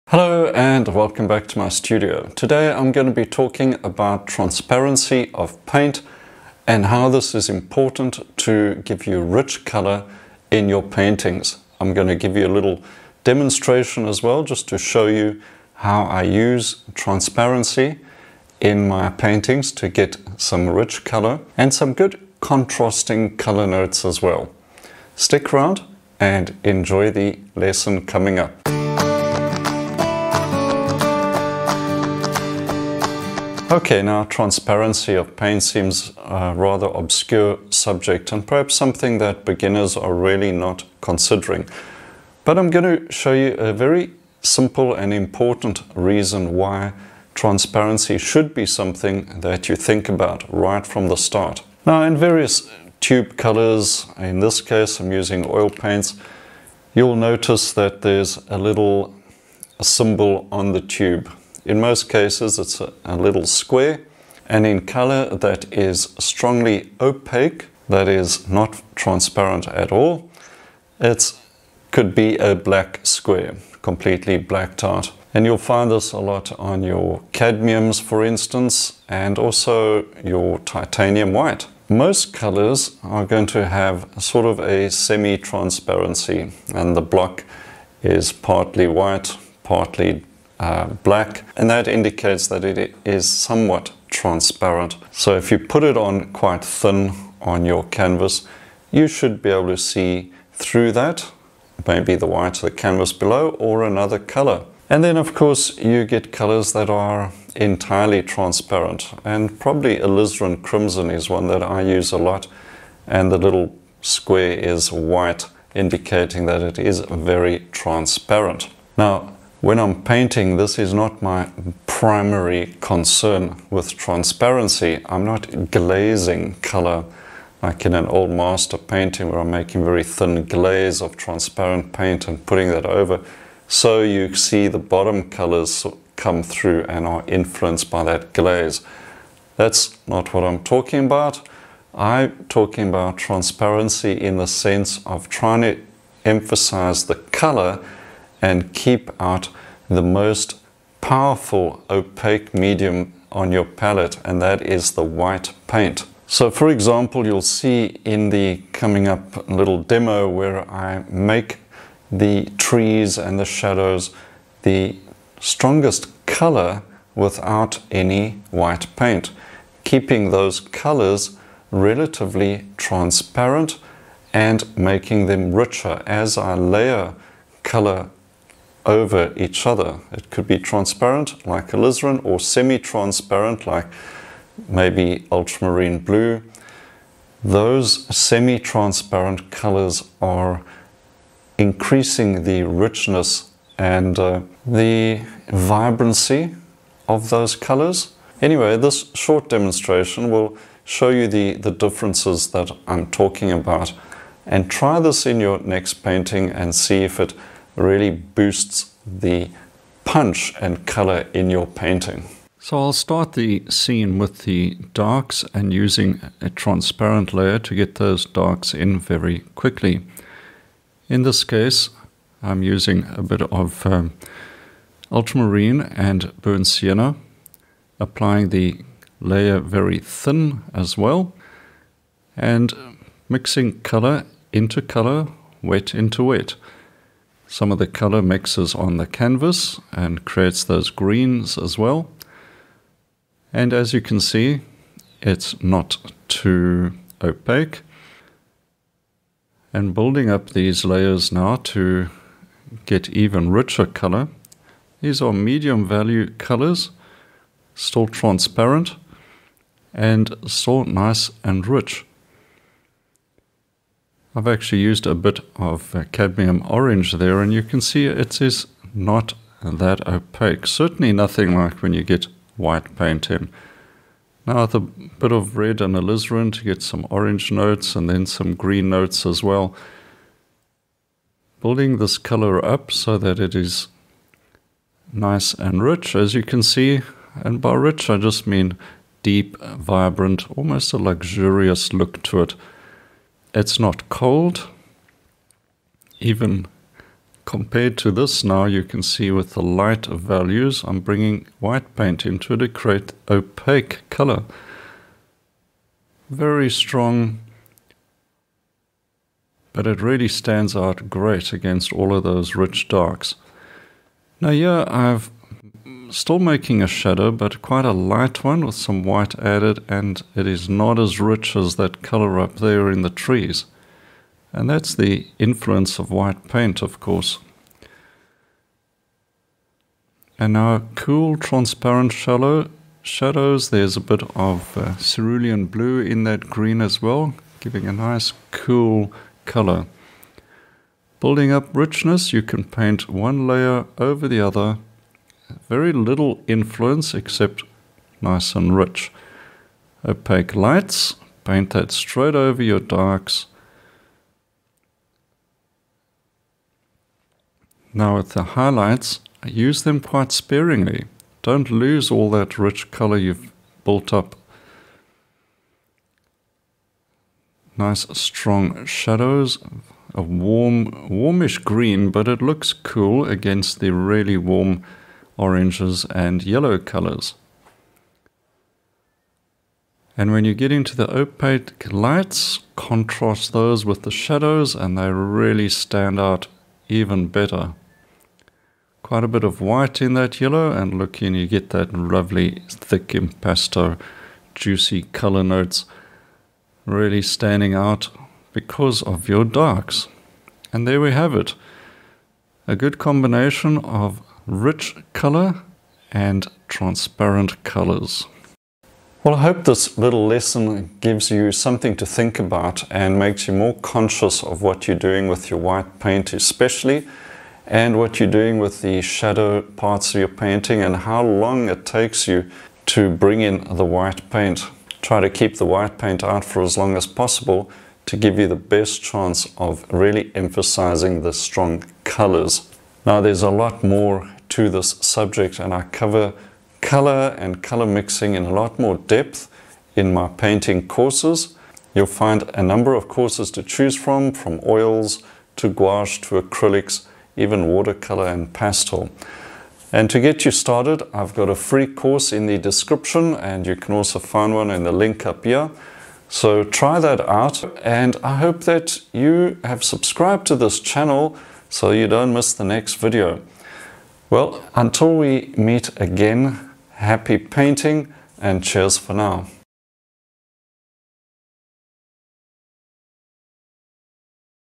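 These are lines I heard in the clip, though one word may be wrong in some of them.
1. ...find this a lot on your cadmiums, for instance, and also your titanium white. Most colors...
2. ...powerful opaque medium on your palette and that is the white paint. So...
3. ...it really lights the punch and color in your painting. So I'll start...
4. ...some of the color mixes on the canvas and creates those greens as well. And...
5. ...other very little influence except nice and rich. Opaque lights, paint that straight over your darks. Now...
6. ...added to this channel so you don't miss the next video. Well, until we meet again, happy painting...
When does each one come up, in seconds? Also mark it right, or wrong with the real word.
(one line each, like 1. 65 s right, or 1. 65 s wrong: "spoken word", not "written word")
1. 75 s right
2. 150 s right
3. 207 s wrong: "boosts", not "lights"
4. 237 s right
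5. 344 s right
6. 459 s wrong: "subscribed", not "added".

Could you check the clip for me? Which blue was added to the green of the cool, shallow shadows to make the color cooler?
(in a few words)
Cerulean blue.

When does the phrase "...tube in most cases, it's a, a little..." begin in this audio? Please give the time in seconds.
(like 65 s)
60 s.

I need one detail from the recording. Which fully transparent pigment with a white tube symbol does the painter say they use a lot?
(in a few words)
Alizarin crimson.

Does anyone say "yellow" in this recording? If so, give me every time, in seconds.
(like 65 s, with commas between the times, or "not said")
376 s, 390 s.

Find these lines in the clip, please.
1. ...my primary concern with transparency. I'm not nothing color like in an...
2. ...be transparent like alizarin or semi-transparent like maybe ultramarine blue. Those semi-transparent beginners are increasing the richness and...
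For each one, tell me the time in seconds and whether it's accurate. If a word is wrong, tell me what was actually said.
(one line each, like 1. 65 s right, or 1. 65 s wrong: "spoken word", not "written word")
1. 121 s wrong: "glazing", not "nothing"
2. 180 s wrong: "colors", not "beginners".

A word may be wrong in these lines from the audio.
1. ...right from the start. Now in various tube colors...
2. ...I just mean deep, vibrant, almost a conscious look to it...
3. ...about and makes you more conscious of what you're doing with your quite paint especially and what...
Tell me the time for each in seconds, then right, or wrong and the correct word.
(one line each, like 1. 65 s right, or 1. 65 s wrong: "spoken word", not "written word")
1. 50 s right
2. 288 s wrong: "luxurious", not "conscious"
3. 412 s wrong: "white", not "quite".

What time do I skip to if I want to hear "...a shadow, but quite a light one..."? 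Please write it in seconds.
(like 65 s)
316 s.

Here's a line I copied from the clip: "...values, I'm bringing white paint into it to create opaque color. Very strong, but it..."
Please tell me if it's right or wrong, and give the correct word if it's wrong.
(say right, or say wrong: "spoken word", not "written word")
right.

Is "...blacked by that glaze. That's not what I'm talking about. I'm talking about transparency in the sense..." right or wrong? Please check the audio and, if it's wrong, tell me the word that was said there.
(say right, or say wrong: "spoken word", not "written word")
wrong: "influenced", not "blacked".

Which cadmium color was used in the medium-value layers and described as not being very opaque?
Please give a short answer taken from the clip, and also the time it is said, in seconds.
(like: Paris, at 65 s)
Cadmium orange, at 266 s.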